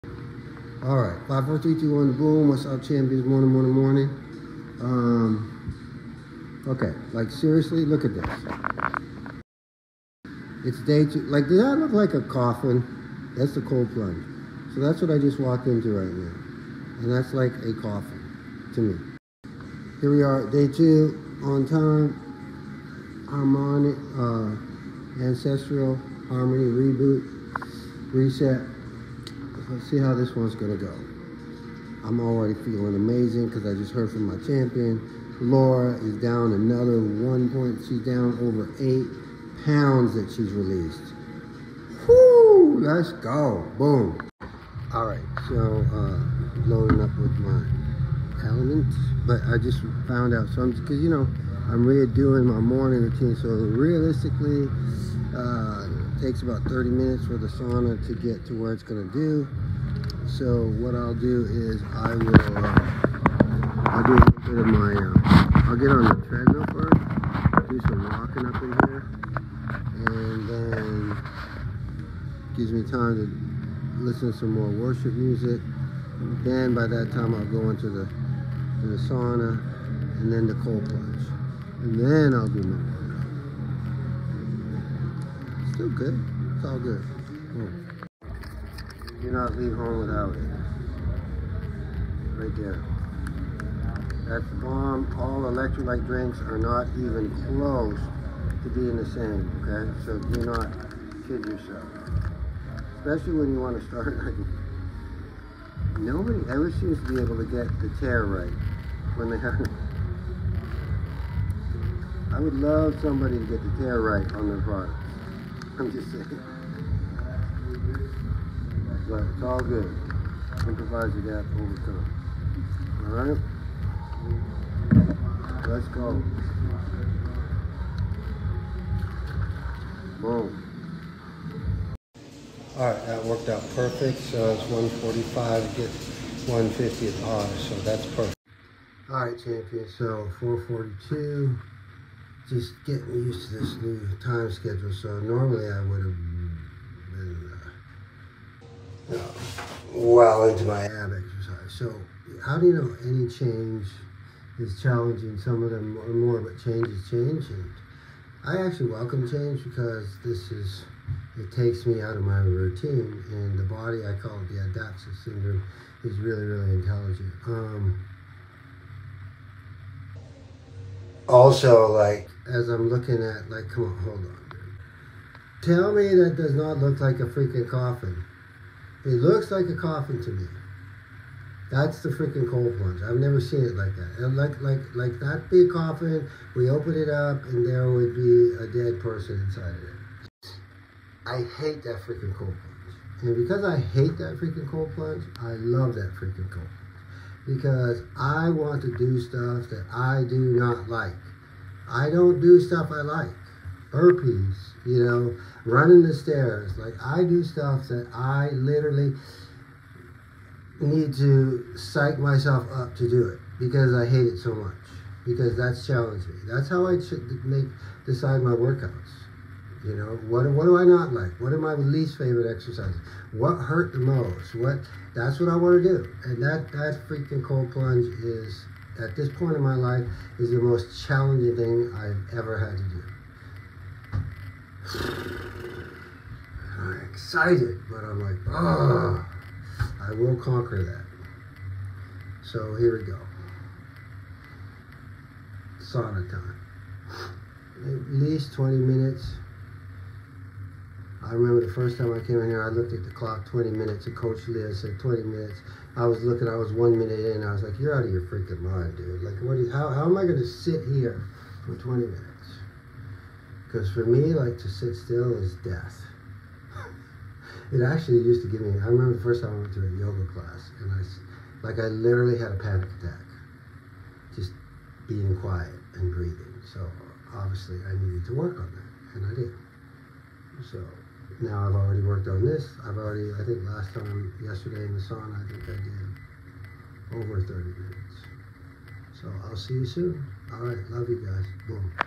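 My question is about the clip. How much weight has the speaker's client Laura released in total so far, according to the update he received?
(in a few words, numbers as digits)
over 8 pounds.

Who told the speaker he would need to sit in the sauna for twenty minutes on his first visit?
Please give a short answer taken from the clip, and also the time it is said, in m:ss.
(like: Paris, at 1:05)
Coach Leah, at 4:14.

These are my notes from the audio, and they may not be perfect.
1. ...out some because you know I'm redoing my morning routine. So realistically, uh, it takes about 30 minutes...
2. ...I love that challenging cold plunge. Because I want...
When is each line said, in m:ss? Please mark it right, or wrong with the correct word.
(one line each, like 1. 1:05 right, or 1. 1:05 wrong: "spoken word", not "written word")
1. 0:50 right
2. 3:15 wrong: "freaking", not "challenging".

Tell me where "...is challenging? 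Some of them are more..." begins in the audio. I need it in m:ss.
2:34.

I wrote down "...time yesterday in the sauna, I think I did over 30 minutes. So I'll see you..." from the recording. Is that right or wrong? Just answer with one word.
right.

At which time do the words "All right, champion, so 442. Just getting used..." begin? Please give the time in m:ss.
2:19.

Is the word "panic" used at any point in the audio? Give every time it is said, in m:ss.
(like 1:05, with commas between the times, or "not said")
4:32.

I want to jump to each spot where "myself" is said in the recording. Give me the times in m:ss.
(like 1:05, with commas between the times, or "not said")
3:32.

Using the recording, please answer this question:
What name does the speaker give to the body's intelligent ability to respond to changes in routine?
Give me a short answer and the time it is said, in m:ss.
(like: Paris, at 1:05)
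adaptive syndrome, at 2:44.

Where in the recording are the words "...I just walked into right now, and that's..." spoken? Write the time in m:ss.
0:15.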